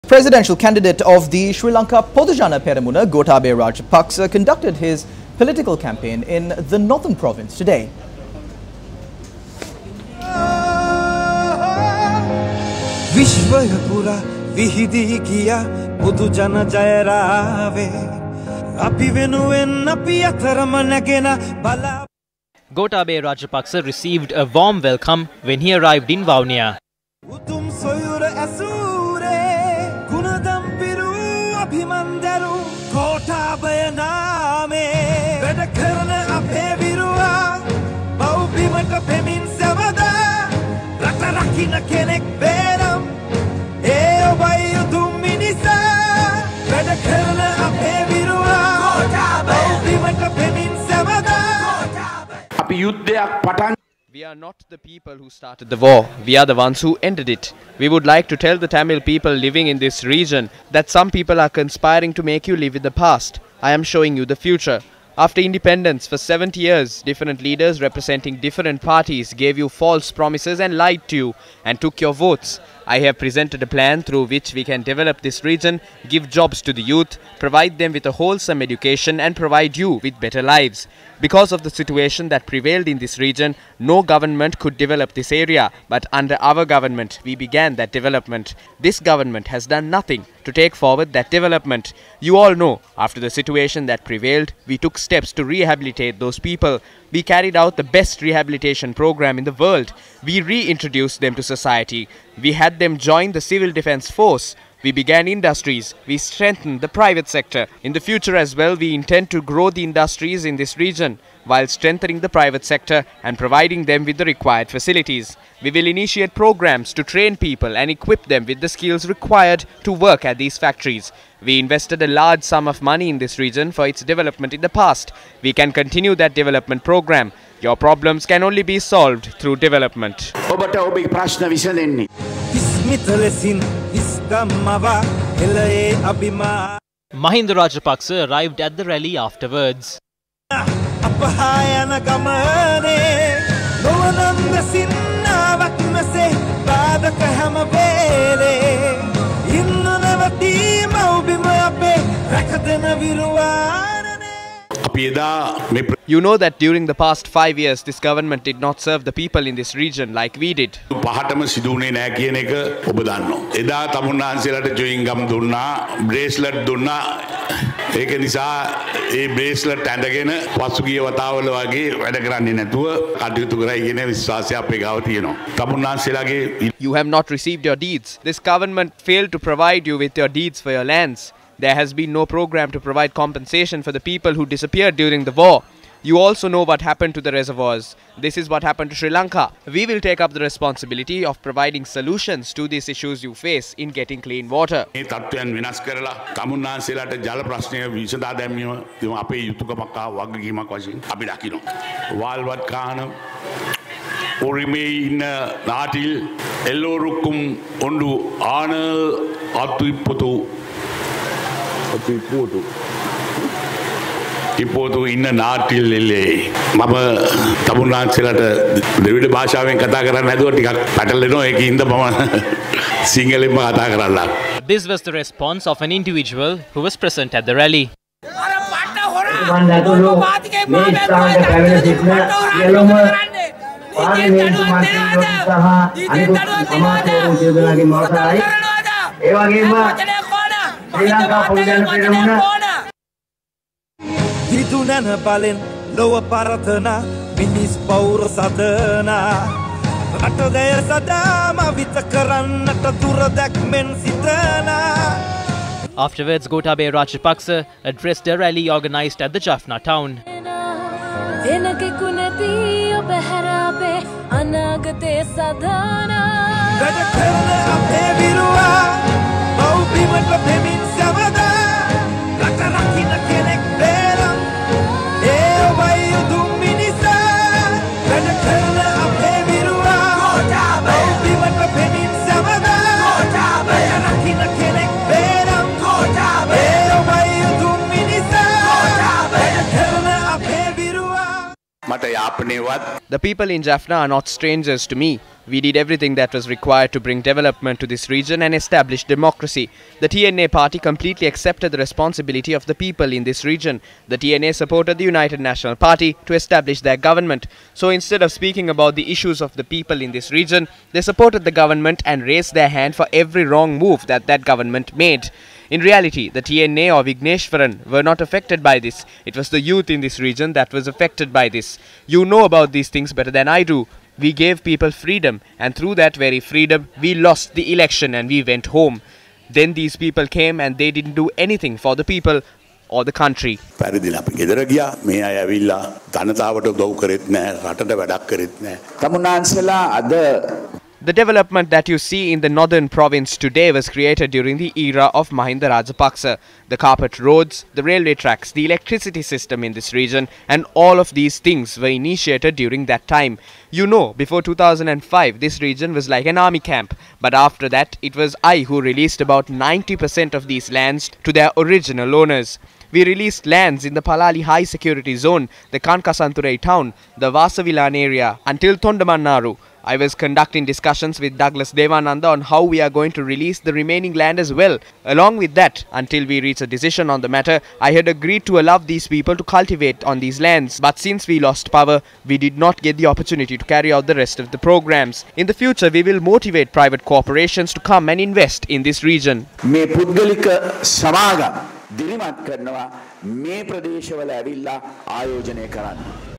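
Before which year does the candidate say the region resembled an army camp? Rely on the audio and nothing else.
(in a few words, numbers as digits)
2005.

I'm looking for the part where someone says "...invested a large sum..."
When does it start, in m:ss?
2:01.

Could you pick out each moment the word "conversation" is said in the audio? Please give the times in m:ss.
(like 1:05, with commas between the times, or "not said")
not said.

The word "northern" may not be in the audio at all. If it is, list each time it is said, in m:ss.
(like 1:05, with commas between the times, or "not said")
0:06, 5:42.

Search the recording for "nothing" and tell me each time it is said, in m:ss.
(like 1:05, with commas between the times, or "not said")
1:29.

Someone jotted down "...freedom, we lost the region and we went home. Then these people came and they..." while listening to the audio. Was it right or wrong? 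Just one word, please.
wrong.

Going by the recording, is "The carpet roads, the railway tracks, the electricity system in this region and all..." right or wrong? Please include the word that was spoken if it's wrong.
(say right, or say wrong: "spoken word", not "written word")
right.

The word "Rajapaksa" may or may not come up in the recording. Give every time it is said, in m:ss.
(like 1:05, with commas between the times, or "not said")
0:03, 0:23, 2:17, 4:16, 5:45.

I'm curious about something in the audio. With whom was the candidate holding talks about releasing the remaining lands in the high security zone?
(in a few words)
Douglas Devananda.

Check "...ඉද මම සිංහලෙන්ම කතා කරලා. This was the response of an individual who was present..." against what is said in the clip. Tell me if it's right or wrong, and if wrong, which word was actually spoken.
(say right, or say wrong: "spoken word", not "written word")
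right.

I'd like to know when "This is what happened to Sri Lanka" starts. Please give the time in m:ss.
3:08.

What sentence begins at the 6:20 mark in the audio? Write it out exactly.
But since we lost power, we did not get the opportunity to carry out the rest of the programs.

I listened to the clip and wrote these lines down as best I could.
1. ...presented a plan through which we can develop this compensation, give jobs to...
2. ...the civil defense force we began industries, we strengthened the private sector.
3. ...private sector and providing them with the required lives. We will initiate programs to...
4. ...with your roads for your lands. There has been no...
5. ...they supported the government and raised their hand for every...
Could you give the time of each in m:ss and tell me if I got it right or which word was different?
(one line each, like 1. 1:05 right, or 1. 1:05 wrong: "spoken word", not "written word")
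1. 1:13 wrong: "region", not "compensation"
2. 1:43 right
3. 1:52 wrong: "facilities", not "lives"
4. 2:59 wrong: "deeds", not "roads"
5. 5:10 right.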